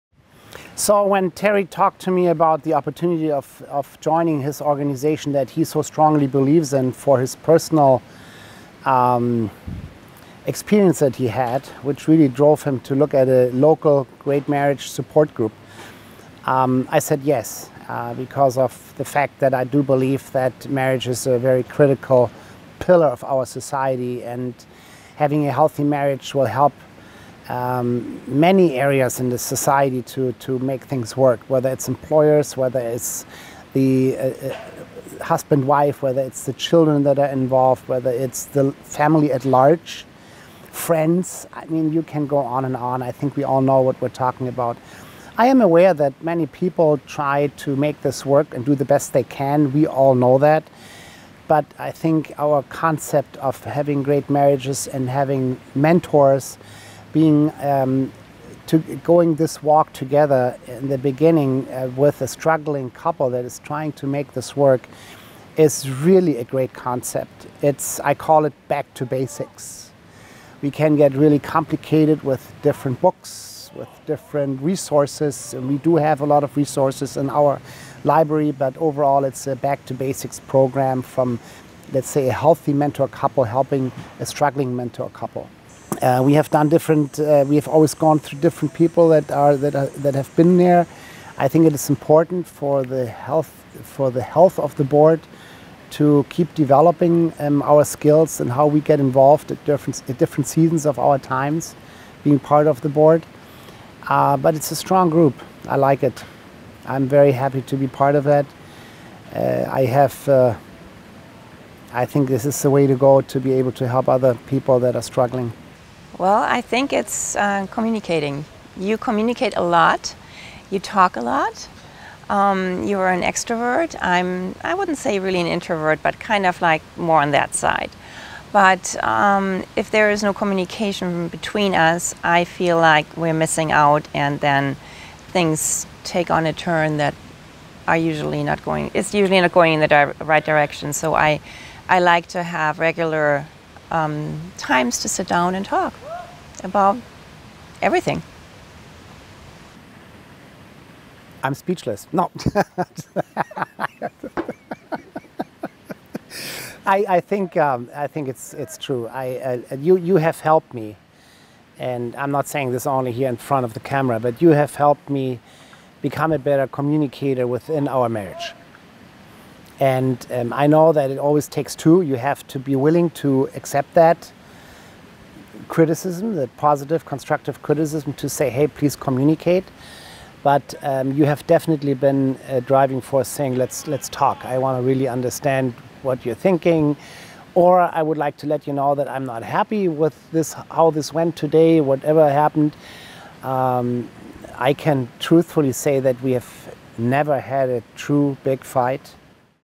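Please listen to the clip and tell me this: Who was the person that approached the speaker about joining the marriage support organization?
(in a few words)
Terry.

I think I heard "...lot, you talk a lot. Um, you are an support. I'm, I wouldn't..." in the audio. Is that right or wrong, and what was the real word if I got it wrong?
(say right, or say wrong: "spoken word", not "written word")
wrong: "extrovert", not "support".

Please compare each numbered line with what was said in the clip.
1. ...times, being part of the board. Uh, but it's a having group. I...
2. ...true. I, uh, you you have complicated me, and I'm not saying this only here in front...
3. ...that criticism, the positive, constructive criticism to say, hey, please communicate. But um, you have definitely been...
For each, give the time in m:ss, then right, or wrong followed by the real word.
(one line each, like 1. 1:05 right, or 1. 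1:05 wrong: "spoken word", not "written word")
1. 1:41 wrong: "strong", not "having"
2. 2:38 wrong: "helped", not "complicated"
3. 2:53 right.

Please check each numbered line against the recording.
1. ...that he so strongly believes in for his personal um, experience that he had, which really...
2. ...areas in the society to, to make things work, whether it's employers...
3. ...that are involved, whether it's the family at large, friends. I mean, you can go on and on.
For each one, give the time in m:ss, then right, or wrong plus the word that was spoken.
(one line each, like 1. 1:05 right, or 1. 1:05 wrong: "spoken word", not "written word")
1. 0:05 right
2. 0:28 right
3. 0:37 right.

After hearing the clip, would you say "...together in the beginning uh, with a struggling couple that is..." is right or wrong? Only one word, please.
right.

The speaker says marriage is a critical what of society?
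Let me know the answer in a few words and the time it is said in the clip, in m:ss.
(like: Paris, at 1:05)
pillar, at 0:22.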